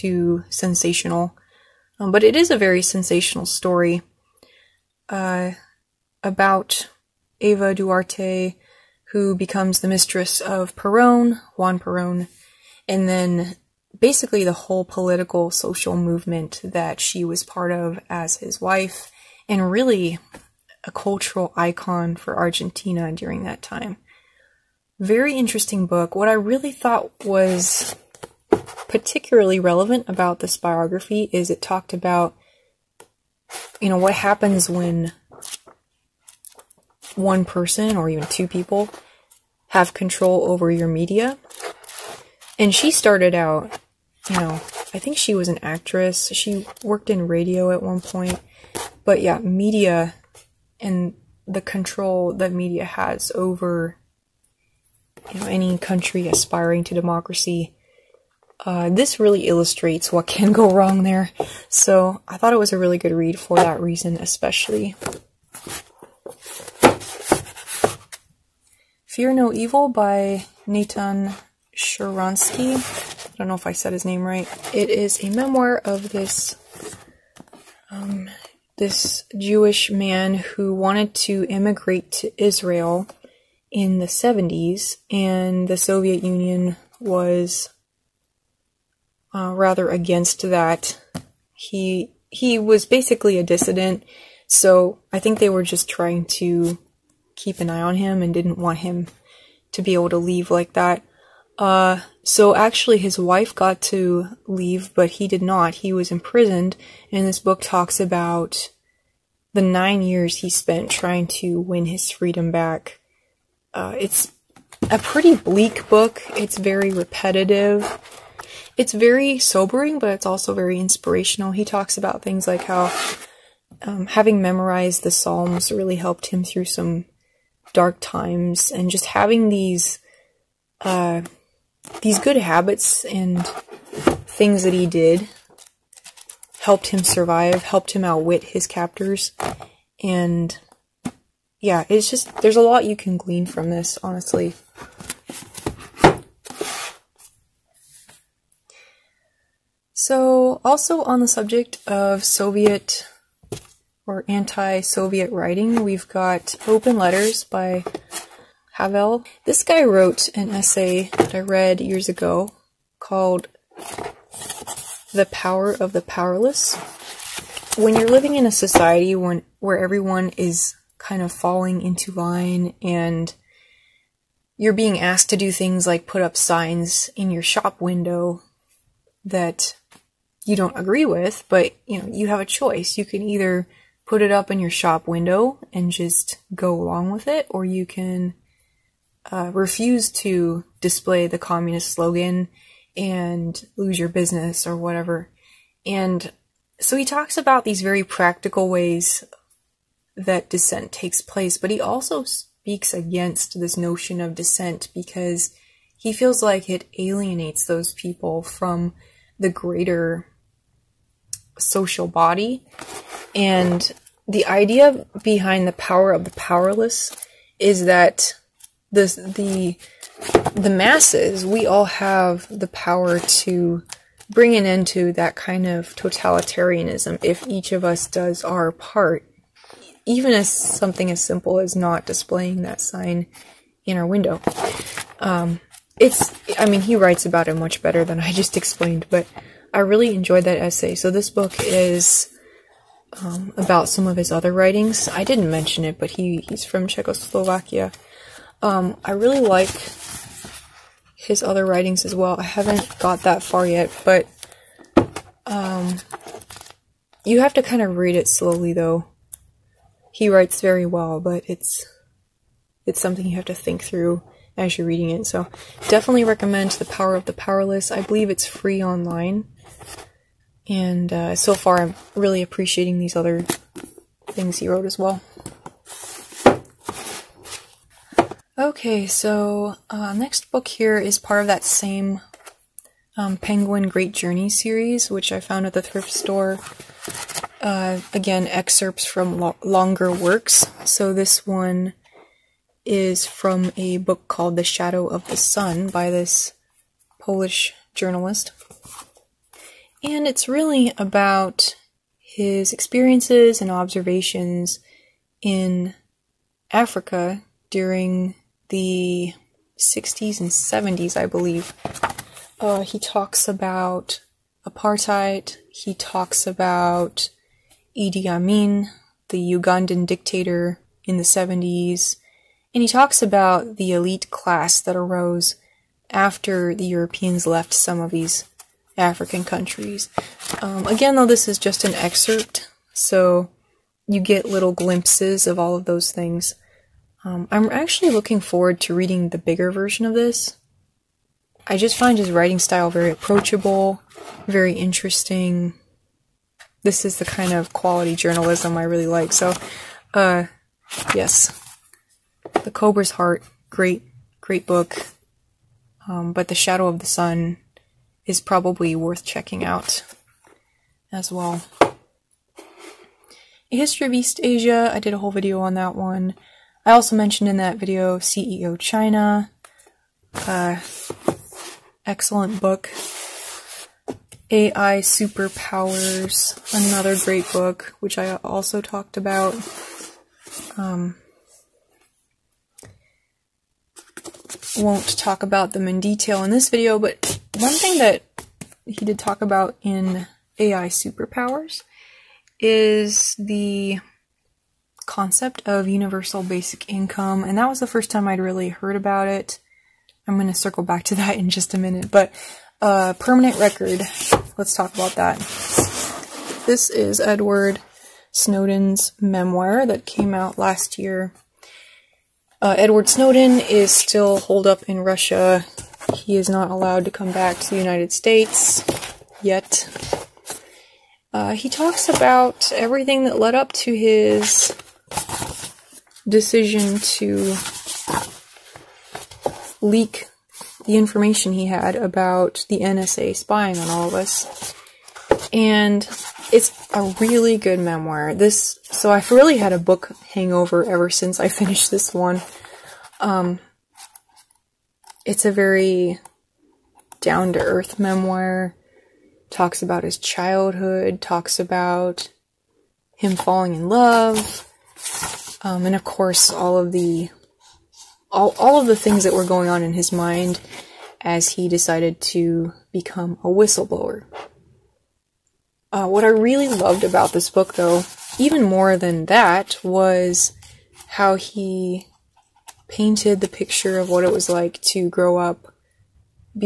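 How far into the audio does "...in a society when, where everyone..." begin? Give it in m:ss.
2:48.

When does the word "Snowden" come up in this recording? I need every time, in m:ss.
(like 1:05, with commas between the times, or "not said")
6:48, 6:53.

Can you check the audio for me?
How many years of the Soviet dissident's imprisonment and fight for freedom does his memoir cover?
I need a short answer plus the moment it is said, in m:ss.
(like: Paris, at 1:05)
9, at 1:49.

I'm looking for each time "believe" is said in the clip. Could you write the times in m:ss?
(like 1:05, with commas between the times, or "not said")
4:28, 5:11.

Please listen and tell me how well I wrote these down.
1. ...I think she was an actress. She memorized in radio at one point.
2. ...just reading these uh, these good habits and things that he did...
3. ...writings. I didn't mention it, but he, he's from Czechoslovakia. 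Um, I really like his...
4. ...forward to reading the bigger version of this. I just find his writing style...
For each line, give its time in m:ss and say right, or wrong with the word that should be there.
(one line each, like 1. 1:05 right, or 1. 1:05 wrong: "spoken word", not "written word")
1. 0:44 wrong: "worked", not "memorized"
2. 2:08 wrong: "having", not "reading"
3. 4:04 right
4. 5:38 right.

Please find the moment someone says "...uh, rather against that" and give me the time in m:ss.
1:29.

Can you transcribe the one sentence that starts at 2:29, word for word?
So, also on the subject of Soviet or anti-Soviet writing, we've got Open Letters by Havel.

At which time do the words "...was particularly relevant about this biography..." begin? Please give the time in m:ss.
0:27.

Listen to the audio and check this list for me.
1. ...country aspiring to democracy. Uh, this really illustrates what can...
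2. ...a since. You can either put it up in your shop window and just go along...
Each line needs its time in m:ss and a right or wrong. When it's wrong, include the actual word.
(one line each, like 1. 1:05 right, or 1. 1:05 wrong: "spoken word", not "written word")
1. 0:55 right
2. 3:02 wrong: "choice", not "since".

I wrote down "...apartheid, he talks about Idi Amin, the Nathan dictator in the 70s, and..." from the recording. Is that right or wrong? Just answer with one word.
wrong.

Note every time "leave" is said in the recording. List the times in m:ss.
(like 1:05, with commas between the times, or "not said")
1:40, 1:44.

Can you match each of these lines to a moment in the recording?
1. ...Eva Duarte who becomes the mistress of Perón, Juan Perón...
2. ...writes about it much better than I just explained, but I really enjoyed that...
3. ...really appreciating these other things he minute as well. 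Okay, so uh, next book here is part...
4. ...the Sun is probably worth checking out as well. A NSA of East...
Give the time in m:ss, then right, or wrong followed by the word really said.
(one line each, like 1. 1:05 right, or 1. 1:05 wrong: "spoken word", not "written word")
1. 0:07 right
2. 3:56 right
3. 4:32 wrong: "wrote", not "minute"
4. 5:56 wrong: "History", not "NSA".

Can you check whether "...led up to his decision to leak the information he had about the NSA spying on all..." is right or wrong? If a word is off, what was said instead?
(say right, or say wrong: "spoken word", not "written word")
right.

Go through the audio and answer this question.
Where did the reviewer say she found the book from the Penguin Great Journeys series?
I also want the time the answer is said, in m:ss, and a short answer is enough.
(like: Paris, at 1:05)
Thrift store, at 4:45.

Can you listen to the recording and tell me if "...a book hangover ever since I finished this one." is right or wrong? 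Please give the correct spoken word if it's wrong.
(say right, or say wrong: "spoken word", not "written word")
right.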